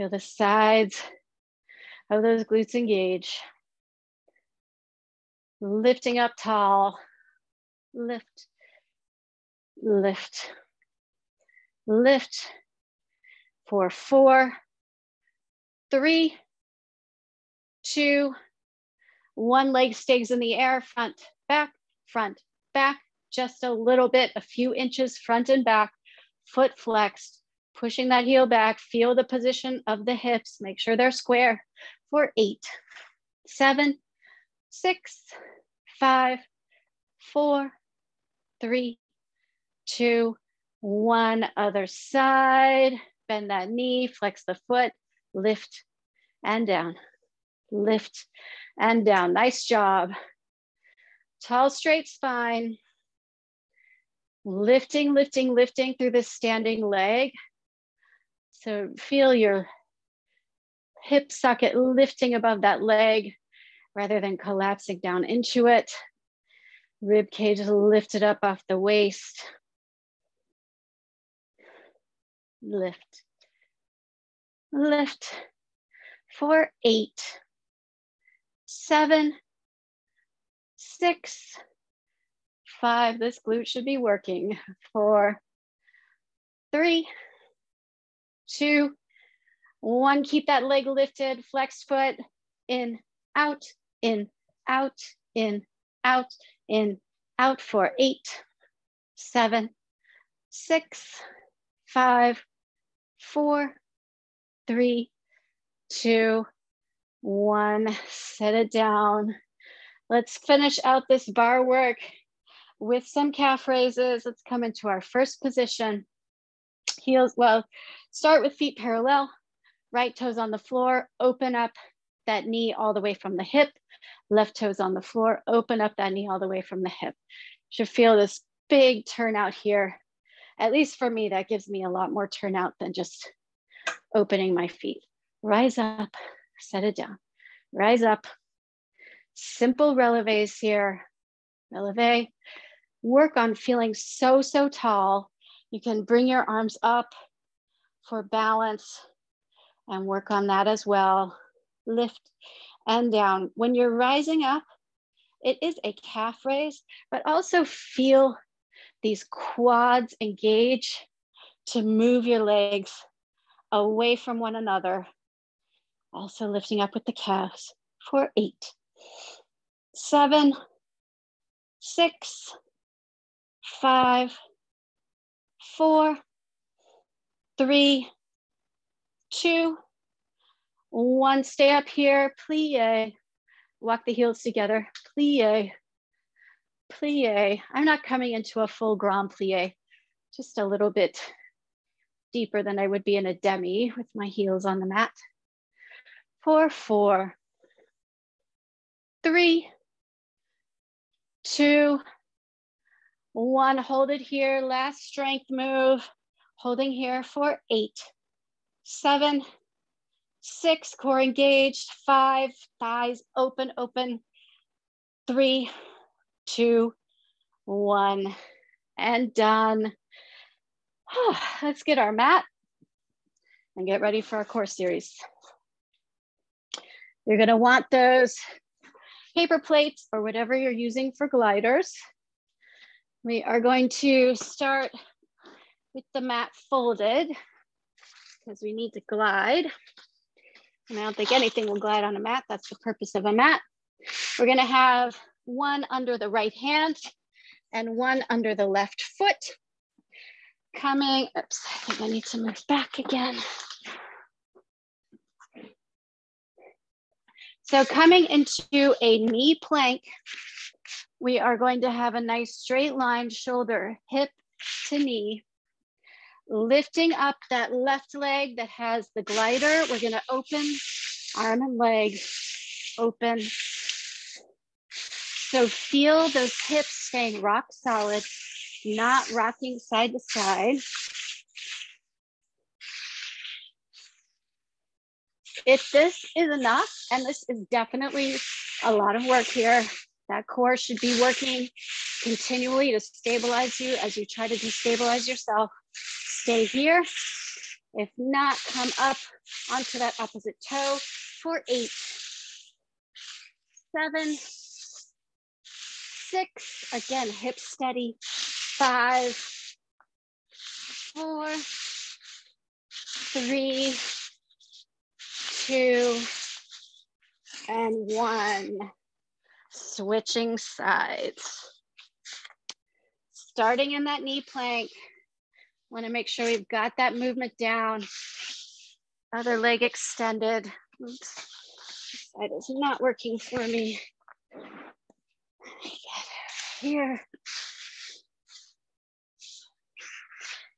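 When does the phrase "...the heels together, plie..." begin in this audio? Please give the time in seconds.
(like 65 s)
184 s.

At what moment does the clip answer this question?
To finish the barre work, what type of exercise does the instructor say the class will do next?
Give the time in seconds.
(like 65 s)
113 s.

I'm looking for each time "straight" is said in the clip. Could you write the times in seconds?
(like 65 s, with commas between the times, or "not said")
51 s, 262 s.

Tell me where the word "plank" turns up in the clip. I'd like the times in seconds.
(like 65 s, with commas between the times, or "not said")
259 s, 324 s.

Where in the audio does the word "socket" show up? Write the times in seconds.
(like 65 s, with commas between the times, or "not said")
61 s.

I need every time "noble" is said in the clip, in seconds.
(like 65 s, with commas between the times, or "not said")
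not said.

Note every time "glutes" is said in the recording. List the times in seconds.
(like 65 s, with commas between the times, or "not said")
2 s, 83 s.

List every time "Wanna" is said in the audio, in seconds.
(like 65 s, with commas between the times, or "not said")
325 s.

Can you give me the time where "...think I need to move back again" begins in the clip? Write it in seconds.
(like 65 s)
251 s.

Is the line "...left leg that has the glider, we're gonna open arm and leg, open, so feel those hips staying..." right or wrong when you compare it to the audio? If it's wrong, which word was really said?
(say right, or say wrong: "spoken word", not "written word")
right.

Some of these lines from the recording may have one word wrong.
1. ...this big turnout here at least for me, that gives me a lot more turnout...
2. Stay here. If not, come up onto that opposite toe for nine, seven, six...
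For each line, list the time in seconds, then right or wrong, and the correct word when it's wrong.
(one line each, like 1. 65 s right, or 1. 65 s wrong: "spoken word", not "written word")
1. 128 s right
2. 295 s wrong: "eight", not "nine".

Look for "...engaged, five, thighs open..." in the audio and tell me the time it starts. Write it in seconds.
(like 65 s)
211 s.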